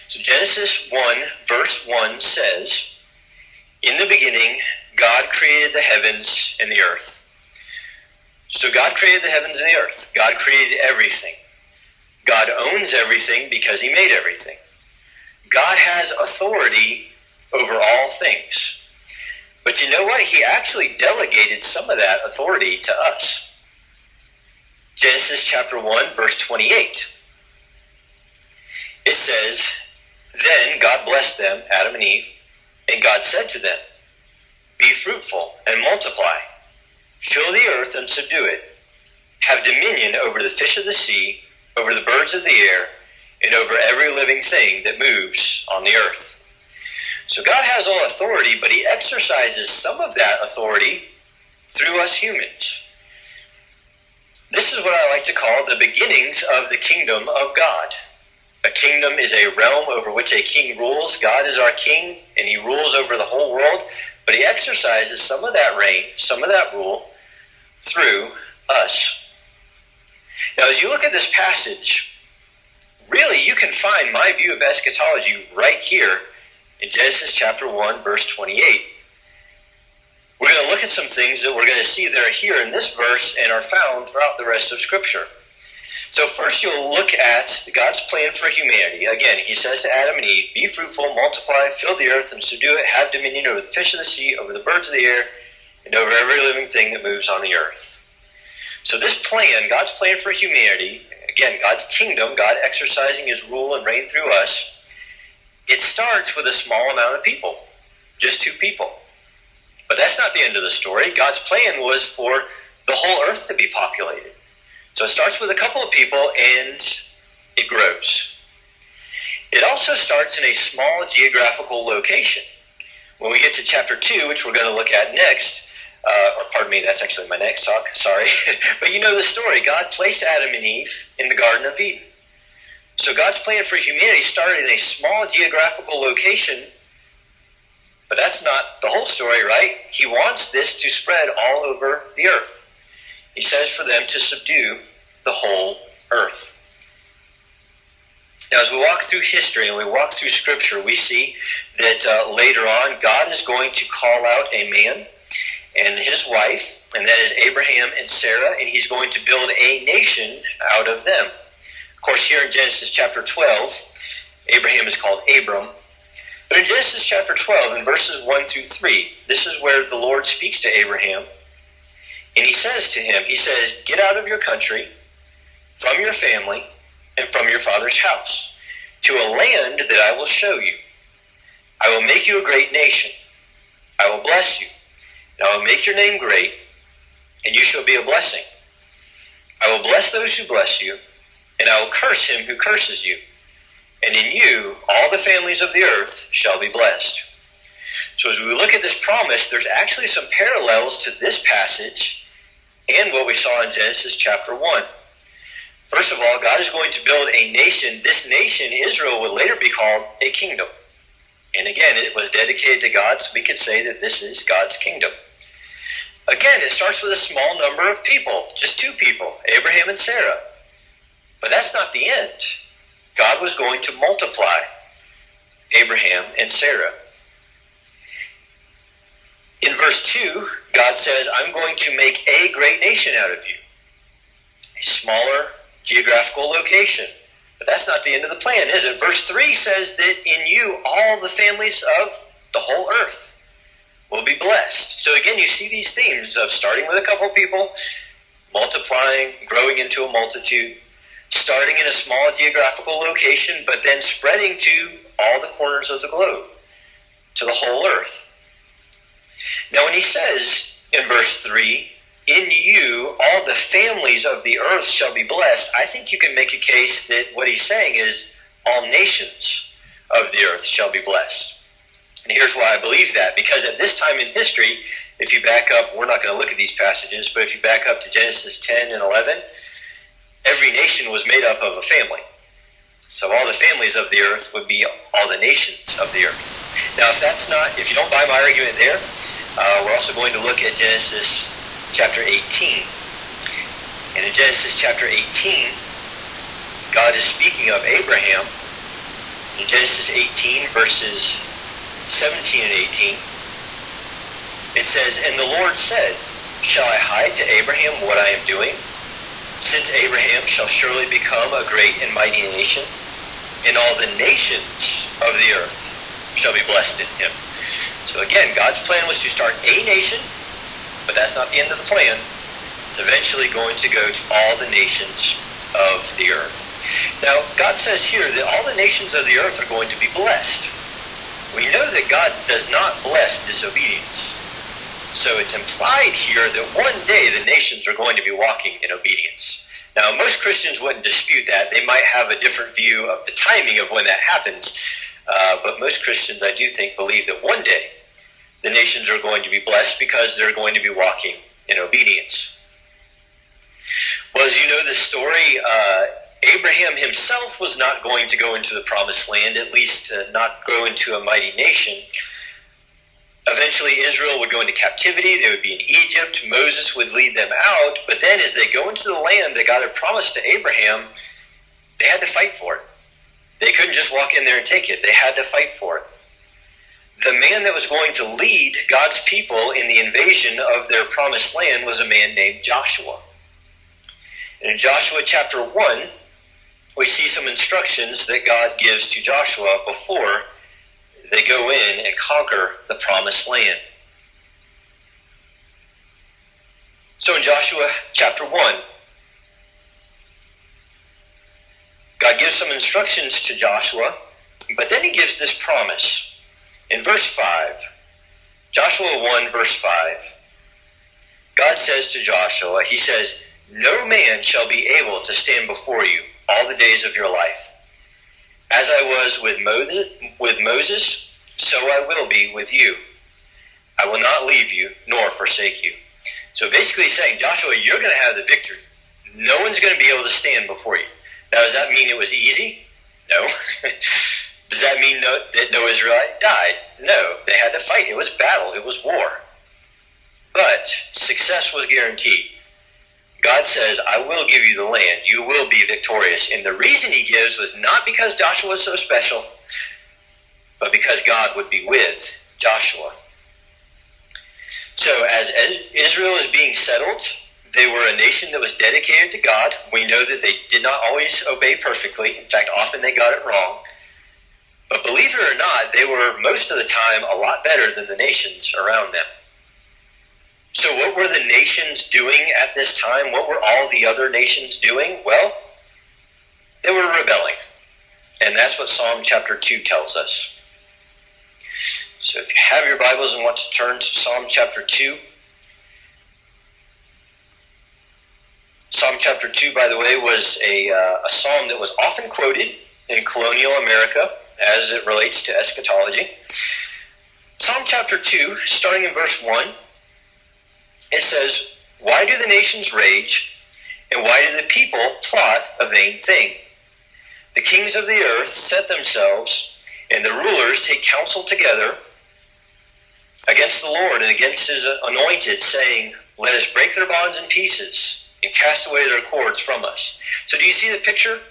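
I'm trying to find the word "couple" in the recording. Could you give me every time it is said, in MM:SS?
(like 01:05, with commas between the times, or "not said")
01:55, 04:07.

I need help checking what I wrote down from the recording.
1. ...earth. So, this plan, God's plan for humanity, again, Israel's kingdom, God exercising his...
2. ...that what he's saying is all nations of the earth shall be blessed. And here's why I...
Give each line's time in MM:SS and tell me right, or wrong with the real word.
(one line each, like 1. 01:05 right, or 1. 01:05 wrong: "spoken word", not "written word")
1. 01:37 wrong: "God", not "Israel"
2. 04:27 right.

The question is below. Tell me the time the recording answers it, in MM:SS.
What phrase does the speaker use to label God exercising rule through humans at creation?
00:55.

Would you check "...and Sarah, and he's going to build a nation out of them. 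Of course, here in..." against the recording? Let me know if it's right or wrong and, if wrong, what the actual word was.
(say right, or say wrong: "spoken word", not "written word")
right.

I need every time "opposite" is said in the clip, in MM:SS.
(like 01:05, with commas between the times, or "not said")
not said.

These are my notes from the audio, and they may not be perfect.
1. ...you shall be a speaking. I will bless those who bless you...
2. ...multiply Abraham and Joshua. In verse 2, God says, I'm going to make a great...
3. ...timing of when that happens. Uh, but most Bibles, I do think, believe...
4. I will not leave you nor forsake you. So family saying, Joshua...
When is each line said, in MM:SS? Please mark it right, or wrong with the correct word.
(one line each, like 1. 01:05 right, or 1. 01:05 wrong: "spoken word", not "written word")
1. 03:07 wrong: "blessing", not "speaking"
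2. 03:43 wrong: "Sarah", not "Joshua"
3. 05:43 wrong: "Christians", not "Bibles"
4. 07:04 wrong: "basically", not "family".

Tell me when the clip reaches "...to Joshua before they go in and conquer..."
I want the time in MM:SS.
06:29.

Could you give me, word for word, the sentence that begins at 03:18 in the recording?
So, as we look at this promise, there's actually some parallels to this passage and what we saw in Genesis chapter 1.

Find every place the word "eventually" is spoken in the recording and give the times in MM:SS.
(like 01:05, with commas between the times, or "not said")
05:22, 06:03.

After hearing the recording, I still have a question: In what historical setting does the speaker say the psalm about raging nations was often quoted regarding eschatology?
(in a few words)
Colonial America.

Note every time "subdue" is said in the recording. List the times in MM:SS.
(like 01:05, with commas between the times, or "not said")
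00:38, 01:32, 02:24.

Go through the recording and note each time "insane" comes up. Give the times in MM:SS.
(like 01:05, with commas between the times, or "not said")
not said.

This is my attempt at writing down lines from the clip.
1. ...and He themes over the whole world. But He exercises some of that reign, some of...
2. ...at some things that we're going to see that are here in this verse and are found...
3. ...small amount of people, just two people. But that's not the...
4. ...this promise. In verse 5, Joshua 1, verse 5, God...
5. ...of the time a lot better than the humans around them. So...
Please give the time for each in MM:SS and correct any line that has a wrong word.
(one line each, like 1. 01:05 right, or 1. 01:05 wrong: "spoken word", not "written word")
1. 01:02 wrong: "rules", not "themes"
2. 01:20 right
3. 01:46 right
4. 06:45 right
5. 07:46 wrong: "nations", not "humans".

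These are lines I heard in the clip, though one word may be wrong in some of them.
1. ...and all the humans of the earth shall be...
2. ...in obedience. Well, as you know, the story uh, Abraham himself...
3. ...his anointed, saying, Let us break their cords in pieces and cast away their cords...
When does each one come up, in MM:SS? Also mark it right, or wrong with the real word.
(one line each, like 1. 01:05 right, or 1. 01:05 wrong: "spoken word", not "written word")
1. 05:13 wrong: "nations", not "humans"
2. 05:51 right
3. 08:34 wrong: "bonds", not "cords".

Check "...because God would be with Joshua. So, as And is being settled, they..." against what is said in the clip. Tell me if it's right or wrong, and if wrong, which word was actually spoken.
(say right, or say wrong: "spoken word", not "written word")
wrong: "Israel", not "And".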